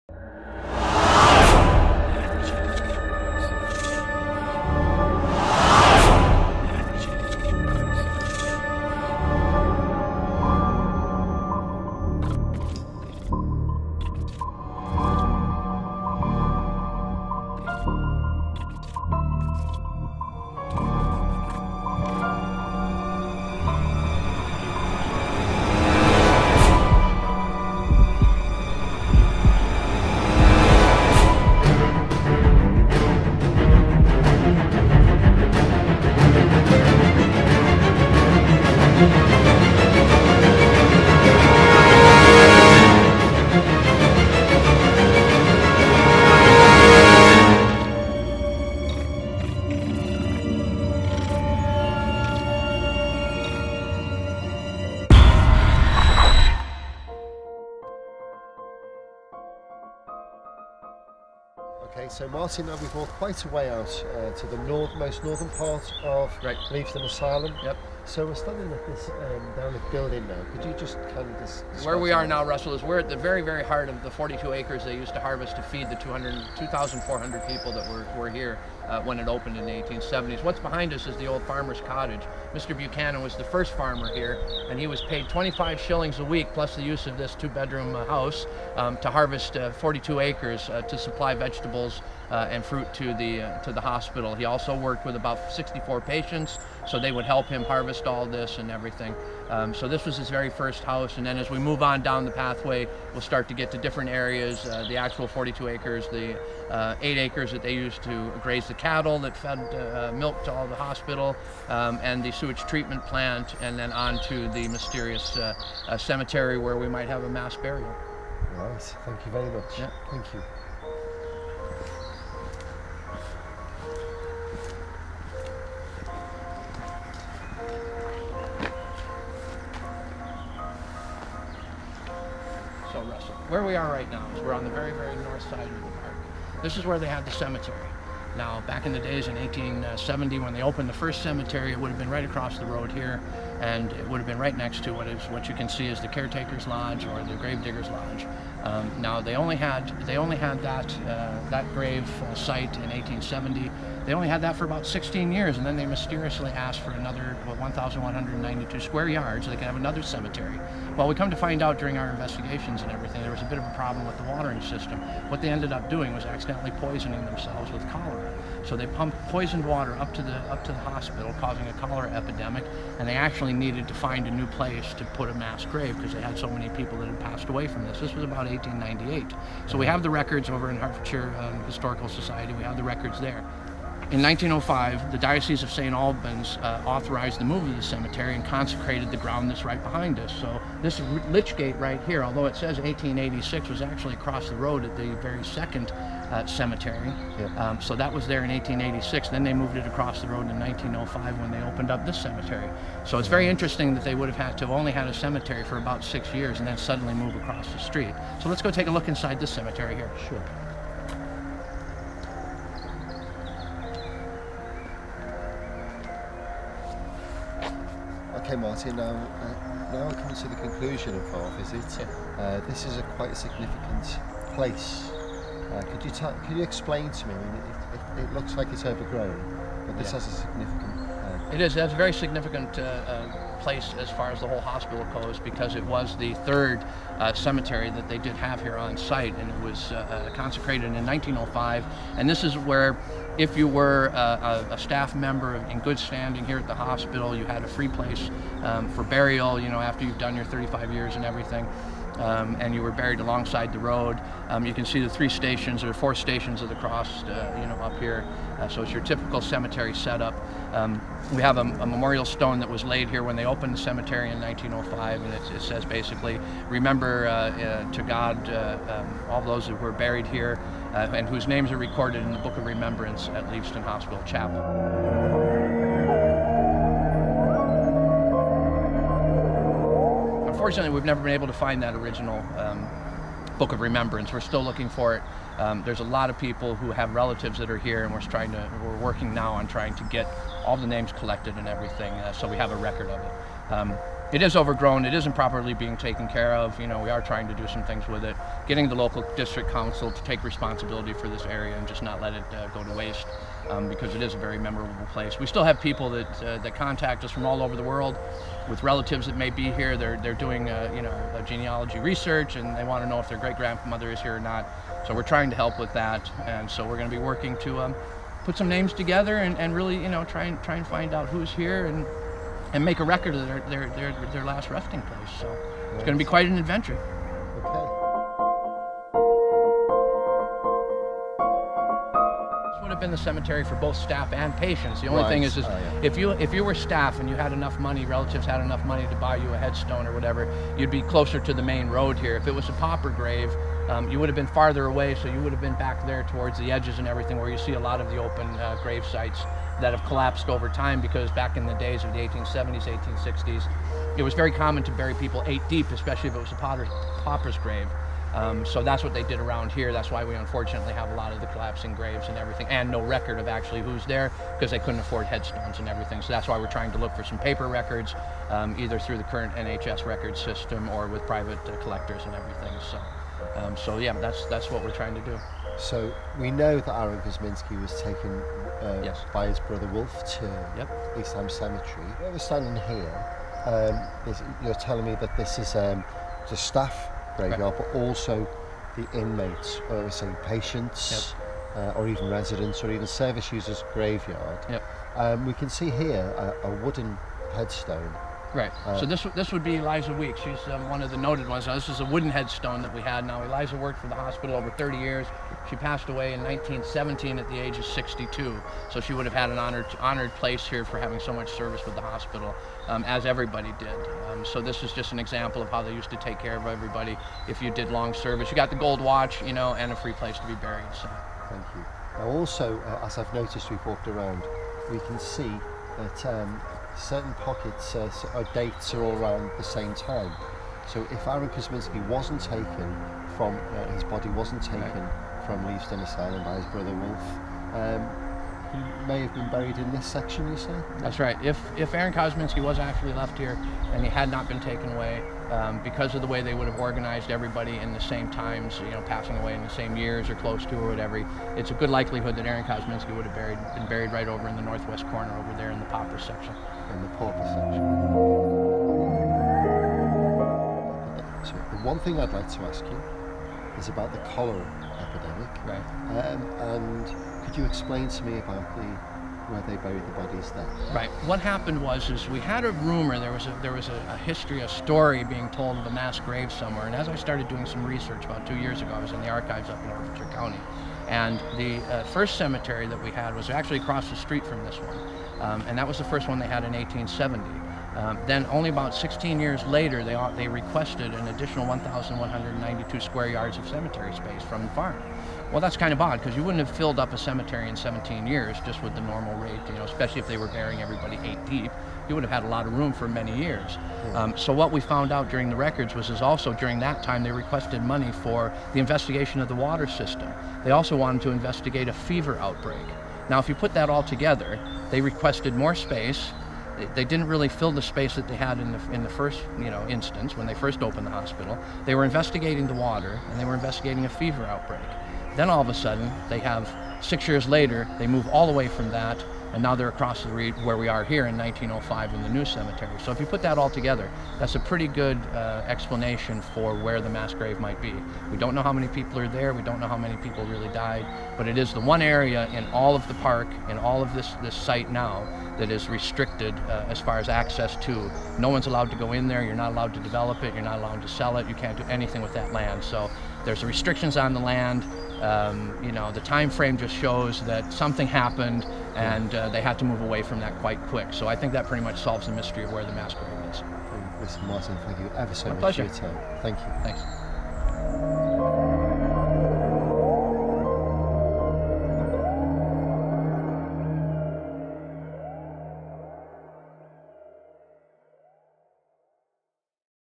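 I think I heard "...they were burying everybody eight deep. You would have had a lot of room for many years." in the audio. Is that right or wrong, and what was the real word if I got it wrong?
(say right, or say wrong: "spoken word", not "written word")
right.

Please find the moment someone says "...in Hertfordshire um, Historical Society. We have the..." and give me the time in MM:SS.
03:00.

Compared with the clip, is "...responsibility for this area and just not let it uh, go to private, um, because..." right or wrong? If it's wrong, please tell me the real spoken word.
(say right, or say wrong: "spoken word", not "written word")
wrong: "waste", not "private".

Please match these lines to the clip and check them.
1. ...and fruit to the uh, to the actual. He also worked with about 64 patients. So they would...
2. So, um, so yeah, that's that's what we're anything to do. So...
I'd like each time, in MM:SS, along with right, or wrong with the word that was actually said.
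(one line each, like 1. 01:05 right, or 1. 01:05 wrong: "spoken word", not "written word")
1. 01:32 wrong: "hospital", not "actual"
2. 06:12 wrong: "trying", not "anything".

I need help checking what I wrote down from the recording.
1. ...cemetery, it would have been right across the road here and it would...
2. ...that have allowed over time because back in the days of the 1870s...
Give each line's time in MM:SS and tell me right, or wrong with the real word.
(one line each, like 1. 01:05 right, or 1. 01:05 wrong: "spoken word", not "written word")
1. 02:21 right
2. 05:49 wrong: "collapsed", not "allowed".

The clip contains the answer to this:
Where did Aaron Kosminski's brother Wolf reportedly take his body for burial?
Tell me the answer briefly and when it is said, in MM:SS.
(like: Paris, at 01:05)
East Ham Cemetery, at 06:21.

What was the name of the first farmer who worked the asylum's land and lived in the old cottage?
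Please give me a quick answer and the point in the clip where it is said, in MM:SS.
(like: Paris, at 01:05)
Buchanan, at 01:22.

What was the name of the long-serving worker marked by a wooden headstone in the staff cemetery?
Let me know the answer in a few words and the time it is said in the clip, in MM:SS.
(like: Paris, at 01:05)
Eliza Weeks, at 06:39.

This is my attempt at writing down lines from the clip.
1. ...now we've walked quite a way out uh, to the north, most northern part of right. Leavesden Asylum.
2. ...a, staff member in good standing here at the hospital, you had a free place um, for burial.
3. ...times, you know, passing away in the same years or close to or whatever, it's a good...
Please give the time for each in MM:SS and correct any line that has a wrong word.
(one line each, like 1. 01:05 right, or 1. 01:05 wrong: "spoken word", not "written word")
1. 01:02 right
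2. 04:04 right
3. 07:28 right.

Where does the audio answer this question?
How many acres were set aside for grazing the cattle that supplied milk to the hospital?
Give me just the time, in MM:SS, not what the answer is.
01:47.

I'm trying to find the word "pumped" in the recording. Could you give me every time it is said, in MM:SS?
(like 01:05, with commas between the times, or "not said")
02:48.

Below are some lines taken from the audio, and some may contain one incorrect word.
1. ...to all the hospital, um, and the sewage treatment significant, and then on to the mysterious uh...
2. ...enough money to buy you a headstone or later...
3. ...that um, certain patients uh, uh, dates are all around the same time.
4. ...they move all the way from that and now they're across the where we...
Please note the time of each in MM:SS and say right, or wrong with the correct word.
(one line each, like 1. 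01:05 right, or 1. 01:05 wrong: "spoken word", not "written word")
1. 01:50 wrong: "plant", not "significant"
2. 05:38 wrong: "whatever", not "later"
3. 07:05 wrong: "pockets", not "patients"
4. 08:47 right.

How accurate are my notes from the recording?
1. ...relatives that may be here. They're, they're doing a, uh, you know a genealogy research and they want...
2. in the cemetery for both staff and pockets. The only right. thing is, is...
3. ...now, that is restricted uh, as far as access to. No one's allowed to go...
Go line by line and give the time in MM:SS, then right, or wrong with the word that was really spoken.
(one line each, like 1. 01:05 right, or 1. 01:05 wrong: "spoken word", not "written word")
1. 05:08 right
2. 05:33 wrong: "patients", not "pockets"
3. 09:04 right.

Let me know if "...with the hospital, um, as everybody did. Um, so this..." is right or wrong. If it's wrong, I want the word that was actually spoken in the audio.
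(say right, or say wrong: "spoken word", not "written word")
right.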